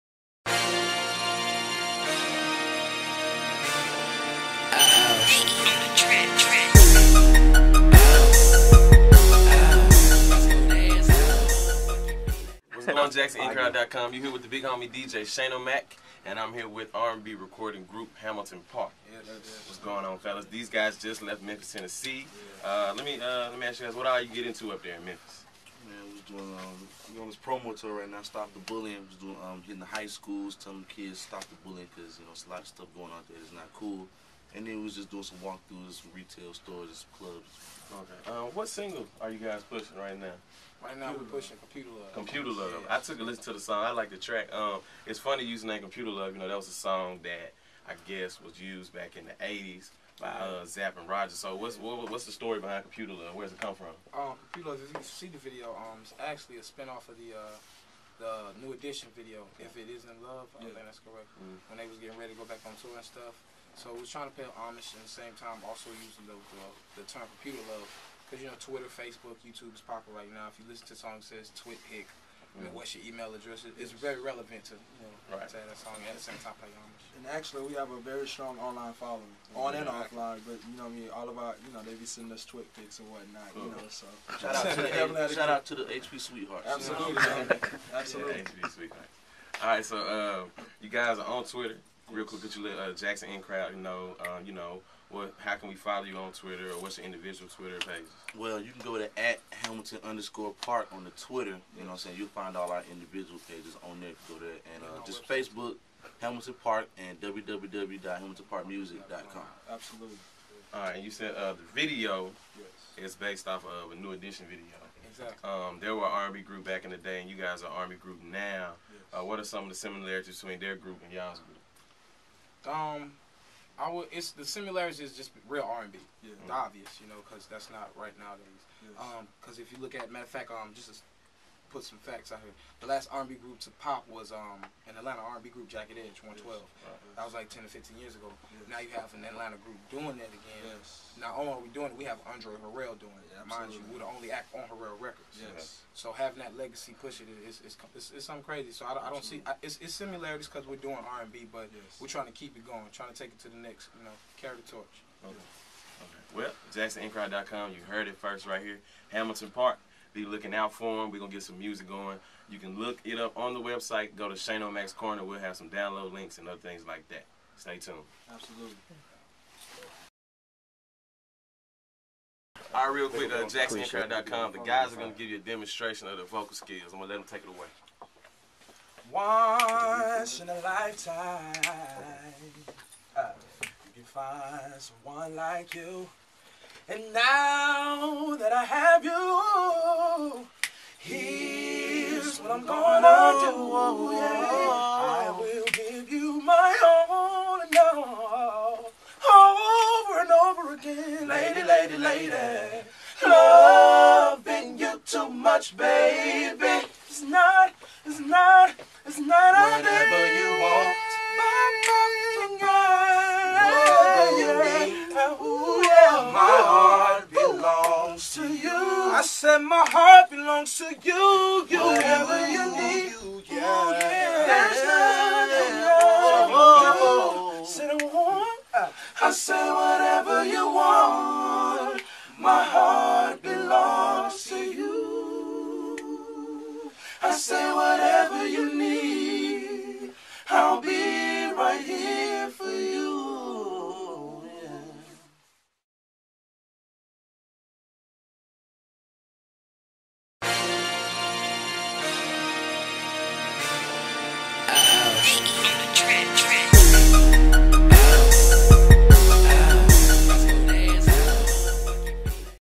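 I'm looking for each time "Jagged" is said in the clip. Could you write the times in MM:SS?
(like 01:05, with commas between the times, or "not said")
02:15.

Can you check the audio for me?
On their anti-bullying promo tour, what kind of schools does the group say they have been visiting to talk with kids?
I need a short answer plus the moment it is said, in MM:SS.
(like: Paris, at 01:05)
High schools, at 00:29.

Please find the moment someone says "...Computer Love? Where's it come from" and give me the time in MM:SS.
00:52.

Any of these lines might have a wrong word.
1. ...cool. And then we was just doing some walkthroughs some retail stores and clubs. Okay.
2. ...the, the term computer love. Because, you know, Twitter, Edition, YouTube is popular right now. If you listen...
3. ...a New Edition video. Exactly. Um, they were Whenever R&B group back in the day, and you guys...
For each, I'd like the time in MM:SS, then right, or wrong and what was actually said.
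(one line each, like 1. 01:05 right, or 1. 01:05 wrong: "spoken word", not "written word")
1. 00:33 right
2. 01:06 wrong: "Facebook", not "Edition"
3. 01:53 wrong: "Army", not "Whenever".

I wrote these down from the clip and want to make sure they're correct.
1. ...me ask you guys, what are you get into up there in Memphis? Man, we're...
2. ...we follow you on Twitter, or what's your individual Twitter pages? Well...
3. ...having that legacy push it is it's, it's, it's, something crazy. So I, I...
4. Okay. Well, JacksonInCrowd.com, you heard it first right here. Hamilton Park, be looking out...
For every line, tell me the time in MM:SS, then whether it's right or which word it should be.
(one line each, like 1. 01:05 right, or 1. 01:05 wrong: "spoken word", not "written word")
1. 00:23 right
2. 01:35 right
3. 02:26 right
4. 02:36 right.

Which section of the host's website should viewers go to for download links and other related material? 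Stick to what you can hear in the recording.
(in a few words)
Shanomak's Corner.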